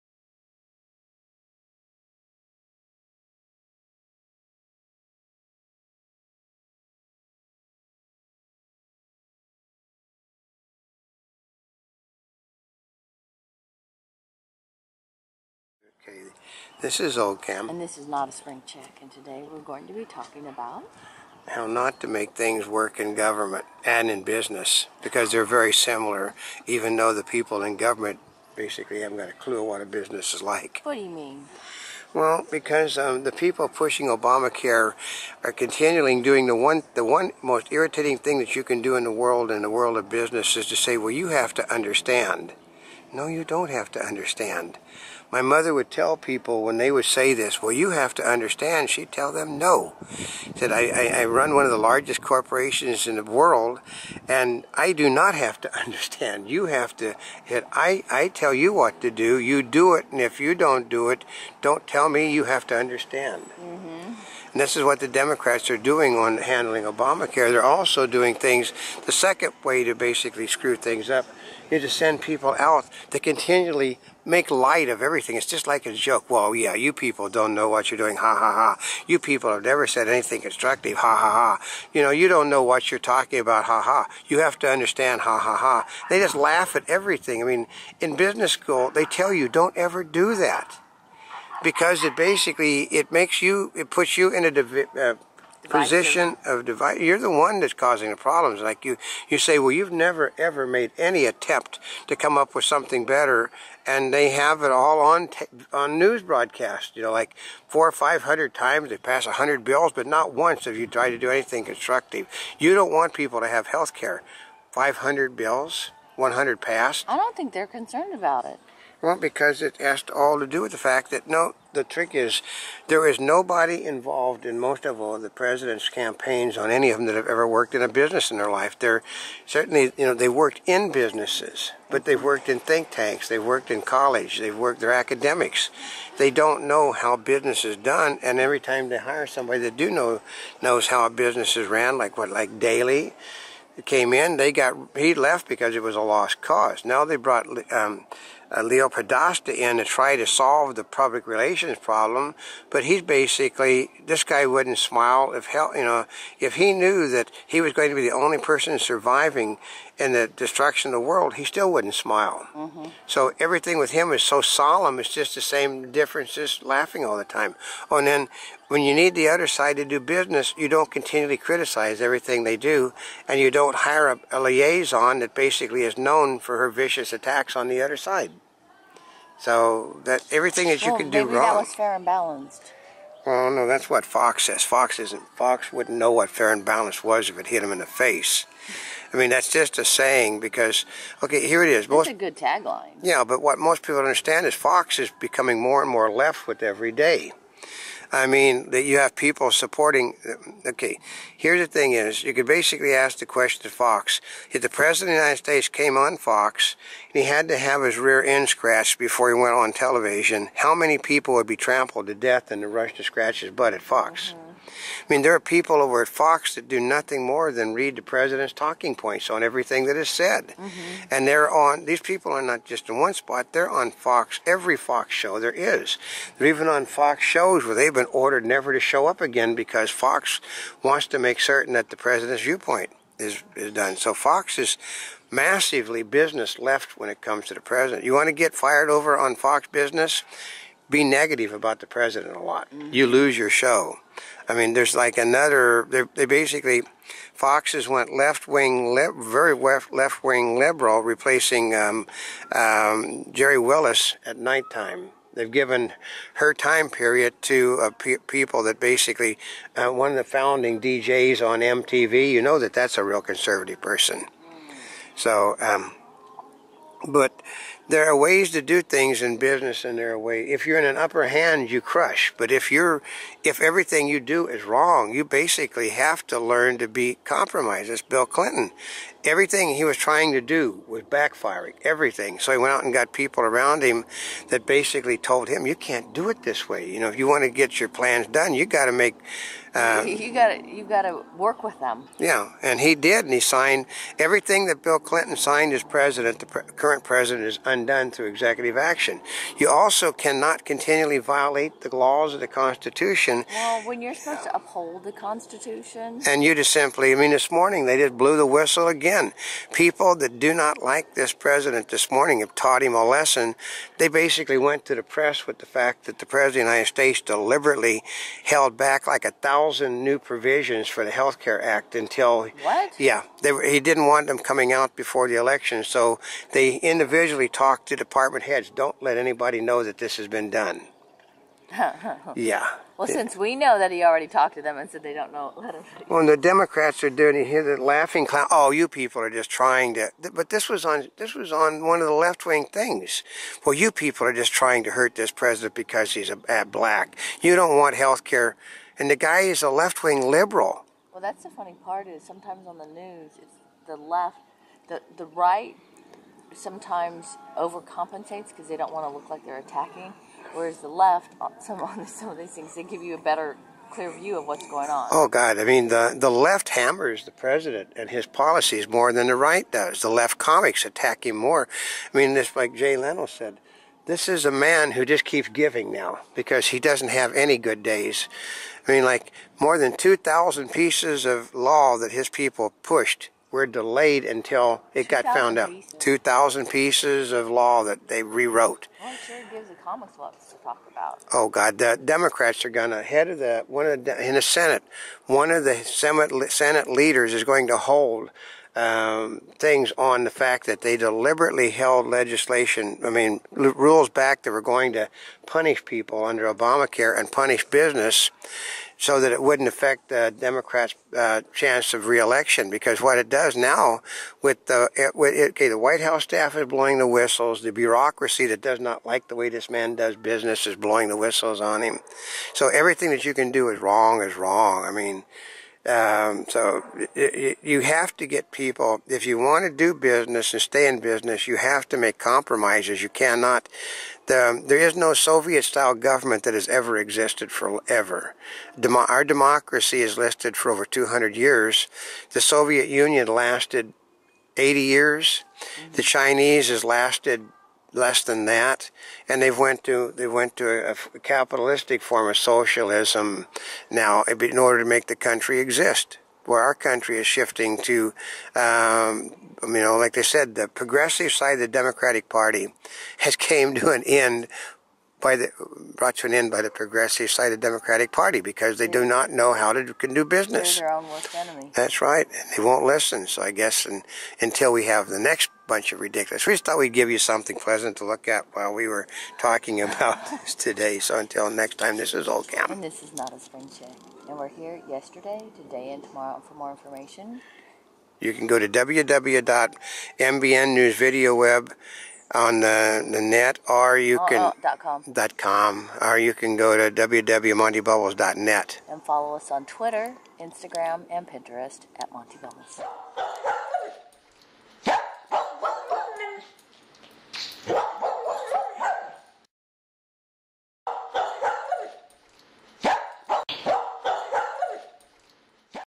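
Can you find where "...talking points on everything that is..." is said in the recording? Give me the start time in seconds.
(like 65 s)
218 s.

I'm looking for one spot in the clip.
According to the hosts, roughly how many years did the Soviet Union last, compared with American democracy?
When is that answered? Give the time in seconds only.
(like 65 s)
444 s.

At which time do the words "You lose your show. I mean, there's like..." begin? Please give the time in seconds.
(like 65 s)
242 s.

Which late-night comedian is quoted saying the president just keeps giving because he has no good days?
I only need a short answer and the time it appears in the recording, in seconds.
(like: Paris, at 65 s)
Jay Leno, at 372 s.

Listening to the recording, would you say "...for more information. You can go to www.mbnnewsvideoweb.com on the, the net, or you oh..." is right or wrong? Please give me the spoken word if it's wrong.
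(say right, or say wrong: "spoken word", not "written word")
right.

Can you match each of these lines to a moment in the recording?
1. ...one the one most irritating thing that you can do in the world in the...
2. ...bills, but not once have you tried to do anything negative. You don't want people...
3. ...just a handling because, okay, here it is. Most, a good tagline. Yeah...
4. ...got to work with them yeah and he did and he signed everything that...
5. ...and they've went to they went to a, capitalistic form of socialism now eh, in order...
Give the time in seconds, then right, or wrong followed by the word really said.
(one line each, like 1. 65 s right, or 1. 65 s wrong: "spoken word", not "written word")
1. 36 s right
2. 109 s wrong: "constructive", not "negative"
3. 189 s wrong: "saying", not "handling"
4. 290 s right
5. 449 s right.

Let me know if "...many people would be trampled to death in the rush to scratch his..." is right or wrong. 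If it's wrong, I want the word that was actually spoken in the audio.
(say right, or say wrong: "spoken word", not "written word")
right.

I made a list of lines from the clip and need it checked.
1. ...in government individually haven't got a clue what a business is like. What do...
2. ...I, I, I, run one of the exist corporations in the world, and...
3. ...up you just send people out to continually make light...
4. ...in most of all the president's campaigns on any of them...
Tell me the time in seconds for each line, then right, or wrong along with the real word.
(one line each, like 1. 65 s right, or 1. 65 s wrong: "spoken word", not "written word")
1. 27 s wrong: "basically", not "individually"
2. 50 s wrong: "largest", not "exist"
3. 71 s right
4. 124 s right.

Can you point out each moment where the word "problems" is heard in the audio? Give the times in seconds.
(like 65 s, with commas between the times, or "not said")
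98 s, 151 s.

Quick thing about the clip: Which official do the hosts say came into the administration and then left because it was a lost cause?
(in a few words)
Daley.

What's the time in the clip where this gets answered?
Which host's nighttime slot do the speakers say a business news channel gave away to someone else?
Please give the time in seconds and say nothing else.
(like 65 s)
253 s.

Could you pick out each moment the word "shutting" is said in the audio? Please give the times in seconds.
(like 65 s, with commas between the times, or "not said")
not said.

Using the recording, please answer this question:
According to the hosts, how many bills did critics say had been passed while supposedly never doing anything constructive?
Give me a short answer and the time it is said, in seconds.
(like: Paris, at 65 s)
100, at 116 s.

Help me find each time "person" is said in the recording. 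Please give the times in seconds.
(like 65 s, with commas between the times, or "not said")
158 s, 263 s.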